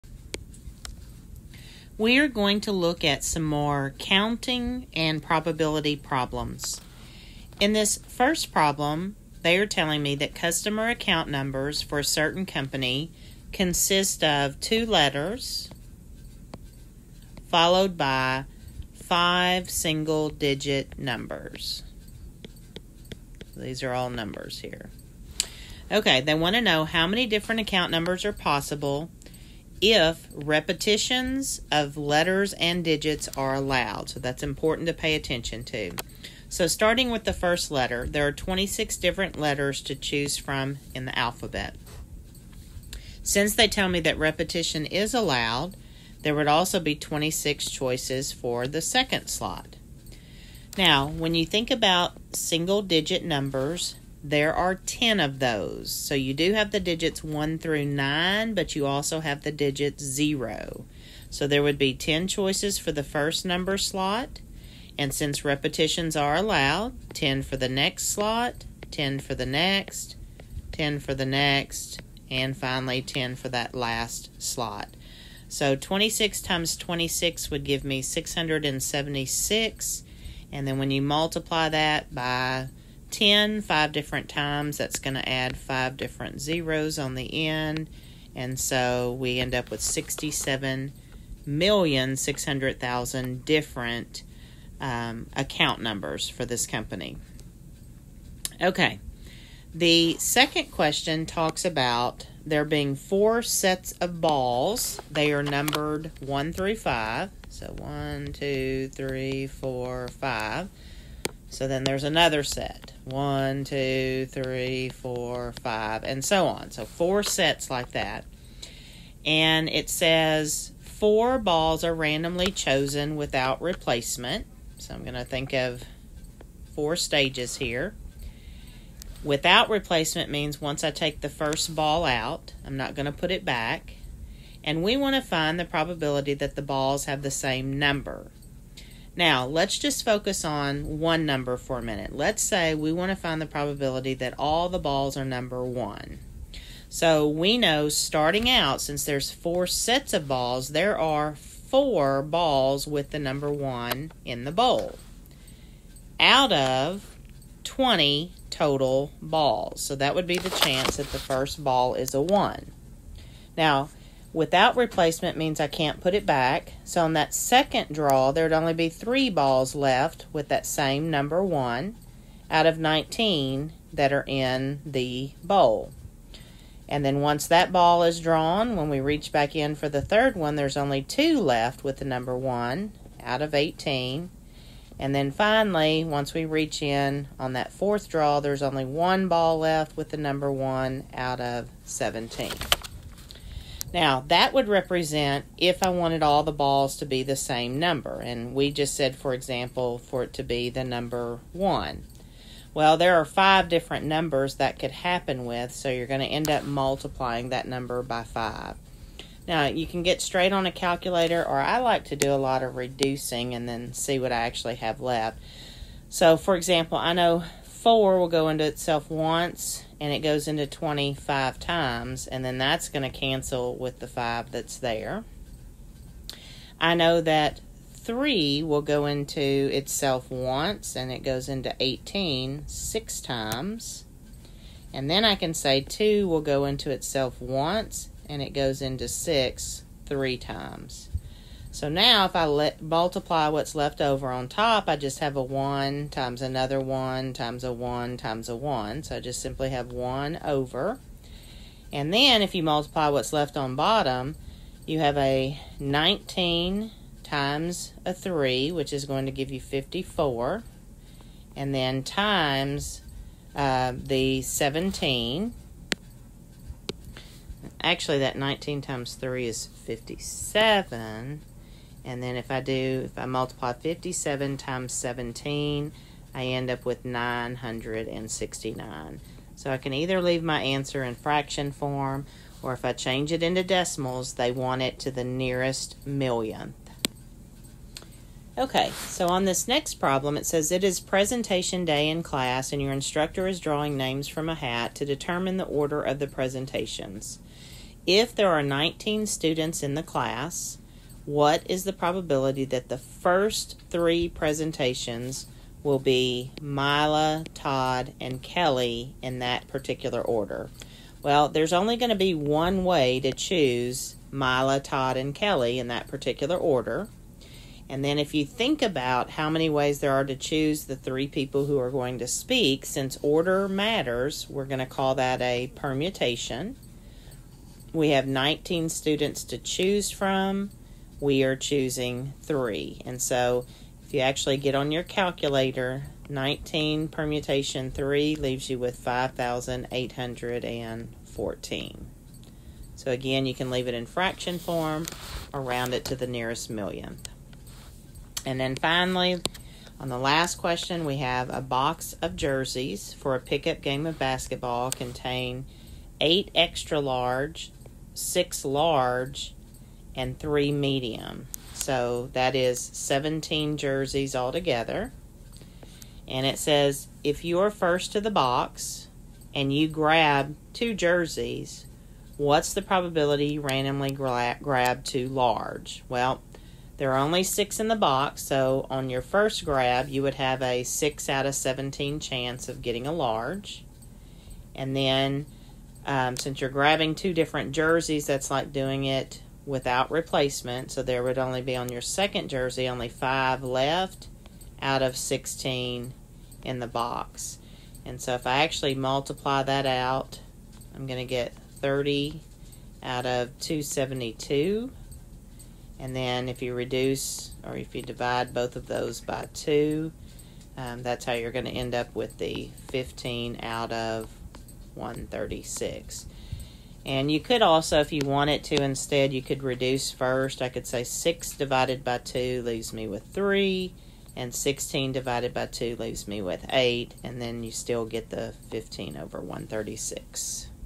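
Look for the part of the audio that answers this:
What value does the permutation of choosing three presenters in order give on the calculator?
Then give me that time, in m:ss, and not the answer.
5:38.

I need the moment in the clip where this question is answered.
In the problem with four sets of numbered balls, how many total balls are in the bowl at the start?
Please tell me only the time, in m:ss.
2:37.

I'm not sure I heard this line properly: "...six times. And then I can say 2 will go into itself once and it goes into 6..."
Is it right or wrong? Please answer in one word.
right.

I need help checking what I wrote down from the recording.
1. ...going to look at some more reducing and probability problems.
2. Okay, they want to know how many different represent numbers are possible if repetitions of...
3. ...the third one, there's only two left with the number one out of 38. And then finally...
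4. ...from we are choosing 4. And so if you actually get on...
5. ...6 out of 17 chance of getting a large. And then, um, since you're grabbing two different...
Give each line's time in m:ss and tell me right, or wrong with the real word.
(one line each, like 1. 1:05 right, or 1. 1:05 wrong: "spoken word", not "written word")
1. 0:02 wrong: "counting", not "reducing"
2. 0:25 wrong: "account", not "represent"
3. 2:59 wrong: "18", not "38"
4. 5:30 wrong: "3", not "4"
5. 6:20 right.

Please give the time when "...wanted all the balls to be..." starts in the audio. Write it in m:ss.
3:15.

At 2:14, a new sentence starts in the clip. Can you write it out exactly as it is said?
And we want to find the probability that the balls have the same number.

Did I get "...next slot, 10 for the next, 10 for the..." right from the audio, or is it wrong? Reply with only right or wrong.
right.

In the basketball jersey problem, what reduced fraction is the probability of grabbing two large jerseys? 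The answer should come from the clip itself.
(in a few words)
15/136.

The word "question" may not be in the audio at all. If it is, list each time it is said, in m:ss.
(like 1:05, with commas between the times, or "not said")
1:40, 5:50.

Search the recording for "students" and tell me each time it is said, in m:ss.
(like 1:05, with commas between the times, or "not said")
4:59, 5:28.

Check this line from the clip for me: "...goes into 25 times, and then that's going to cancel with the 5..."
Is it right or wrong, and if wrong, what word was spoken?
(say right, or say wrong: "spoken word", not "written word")
right.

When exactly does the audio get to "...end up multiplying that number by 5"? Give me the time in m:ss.
3:26.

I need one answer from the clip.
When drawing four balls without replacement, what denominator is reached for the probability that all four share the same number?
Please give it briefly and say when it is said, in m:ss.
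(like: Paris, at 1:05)
969, at 4:37.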